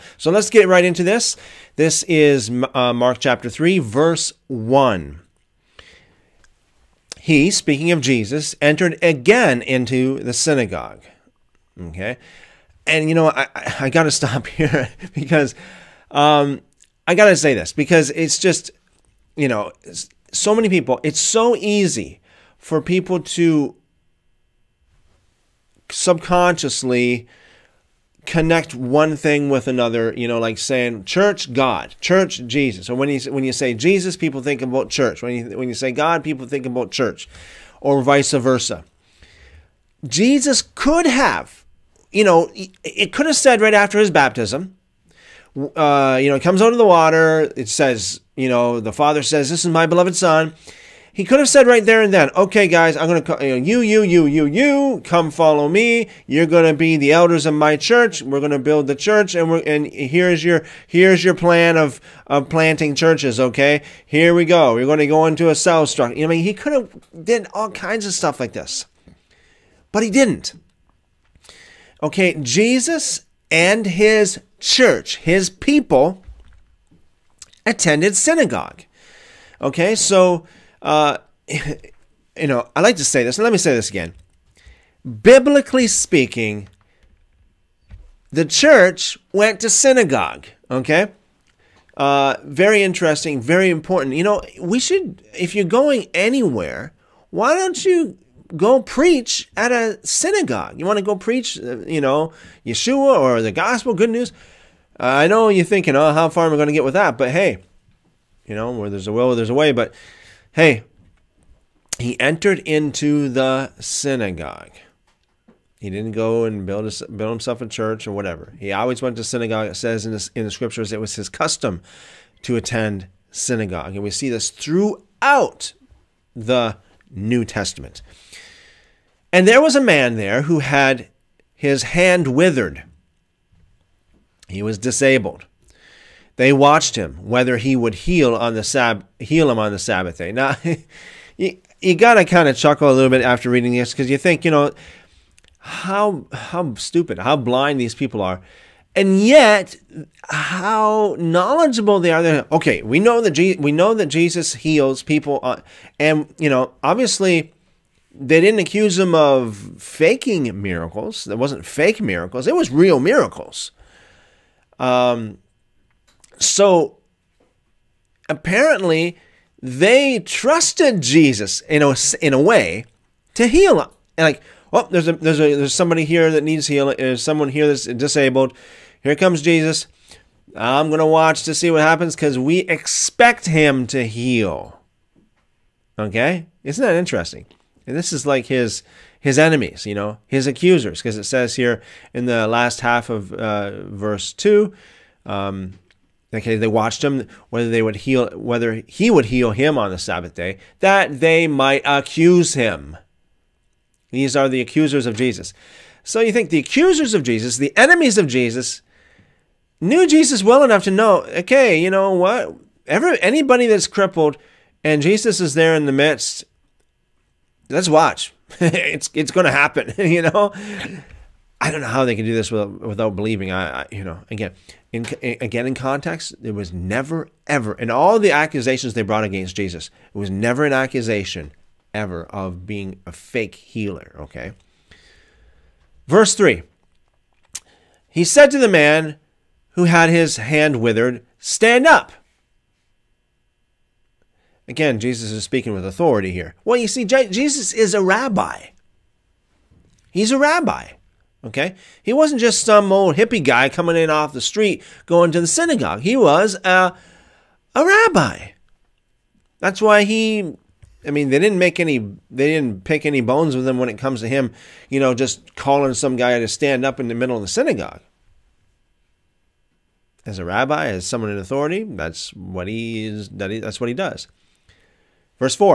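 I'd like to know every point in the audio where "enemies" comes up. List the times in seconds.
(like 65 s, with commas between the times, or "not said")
189 s, 207 s.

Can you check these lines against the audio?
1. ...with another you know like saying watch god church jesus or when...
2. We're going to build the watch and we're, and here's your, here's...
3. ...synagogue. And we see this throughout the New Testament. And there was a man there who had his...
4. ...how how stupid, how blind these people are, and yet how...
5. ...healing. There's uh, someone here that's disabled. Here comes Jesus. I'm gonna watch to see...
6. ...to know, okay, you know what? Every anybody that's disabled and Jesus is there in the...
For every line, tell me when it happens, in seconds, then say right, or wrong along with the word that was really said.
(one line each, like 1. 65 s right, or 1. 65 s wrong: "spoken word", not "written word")
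1. 29 s wrong: "church", not "watch"
2. 58 s wrong: "church", not "watch"
3. 123 s right
4. 145 s right
5. 176 s right
6. 210 s wrong: "crippled", not "disabled".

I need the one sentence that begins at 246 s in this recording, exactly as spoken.
Well, you see, Jesus is a rabbi.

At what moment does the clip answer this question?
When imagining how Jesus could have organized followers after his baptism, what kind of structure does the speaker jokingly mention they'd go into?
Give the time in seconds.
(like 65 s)
65 s.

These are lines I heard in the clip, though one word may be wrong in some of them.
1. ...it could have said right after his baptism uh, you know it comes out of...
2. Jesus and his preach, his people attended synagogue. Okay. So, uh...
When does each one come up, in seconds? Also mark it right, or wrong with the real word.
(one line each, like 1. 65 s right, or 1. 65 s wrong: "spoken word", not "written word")
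1. 42 s right
2. 72 s wrong: "church", not "preach".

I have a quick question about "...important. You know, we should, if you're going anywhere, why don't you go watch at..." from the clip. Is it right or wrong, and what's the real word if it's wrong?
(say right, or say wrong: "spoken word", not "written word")
wrong: "preach", not "watch".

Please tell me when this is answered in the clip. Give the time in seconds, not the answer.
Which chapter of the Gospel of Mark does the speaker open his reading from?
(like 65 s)
3 s.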